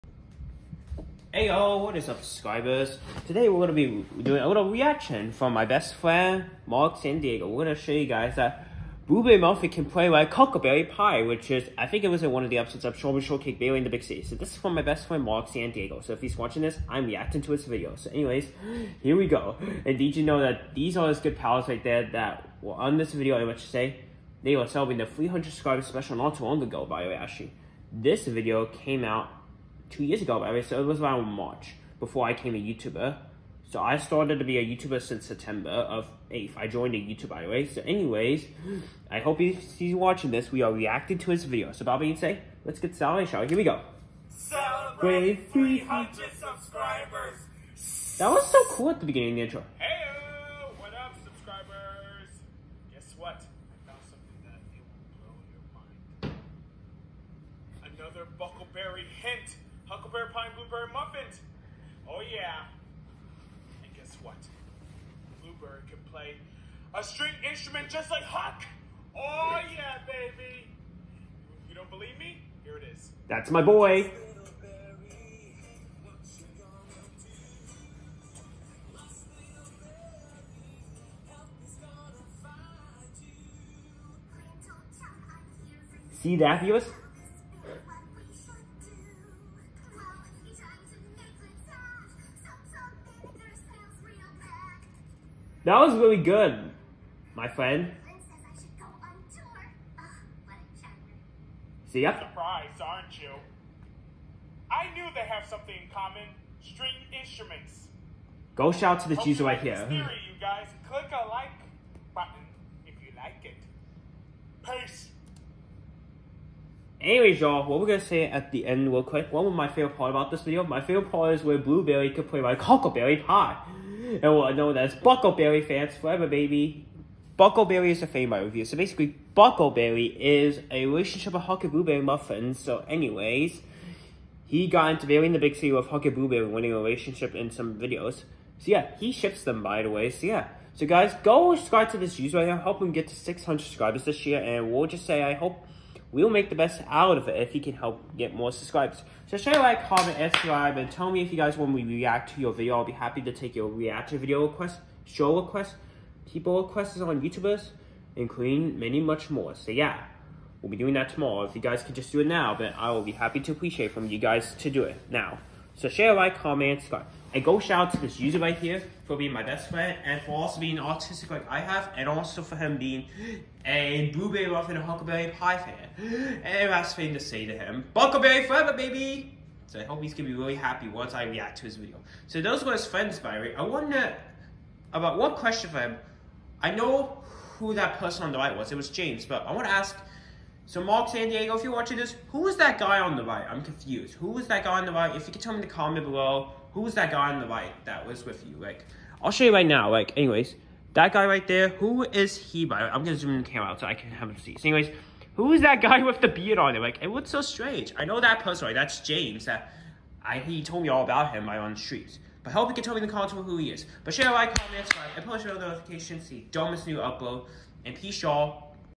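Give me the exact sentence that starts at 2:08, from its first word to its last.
So basically, Buckleberry is a relationship of Huckleberry Blueberry muffins.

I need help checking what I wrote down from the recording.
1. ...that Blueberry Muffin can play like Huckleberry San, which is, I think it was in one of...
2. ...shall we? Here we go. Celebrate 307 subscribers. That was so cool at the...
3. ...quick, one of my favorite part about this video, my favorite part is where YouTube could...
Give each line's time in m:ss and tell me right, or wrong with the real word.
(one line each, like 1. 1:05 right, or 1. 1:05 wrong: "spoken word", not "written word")
1. 0:08 wrong: "Pie", not "San"
2. 0:43 wrong: "300", not "307"
3. 1:59 wrong: "Blueberry", not "YouTube".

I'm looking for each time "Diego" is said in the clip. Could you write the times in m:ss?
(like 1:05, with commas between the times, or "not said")
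0:07, 0:15, 3:11.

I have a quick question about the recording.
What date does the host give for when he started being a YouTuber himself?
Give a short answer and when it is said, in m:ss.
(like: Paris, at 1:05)
September 8, at 0:35.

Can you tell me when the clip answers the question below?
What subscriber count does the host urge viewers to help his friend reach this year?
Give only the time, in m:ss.
2:23.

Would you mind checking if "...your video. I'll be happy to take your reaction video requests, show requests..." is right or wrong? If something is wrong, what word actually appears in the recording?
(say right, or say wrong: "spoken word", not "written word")
right.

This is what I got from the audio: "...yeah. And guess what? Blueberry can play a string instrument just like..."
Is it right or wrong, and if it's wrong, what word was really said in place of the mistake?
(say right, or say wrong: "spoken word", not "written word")
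right.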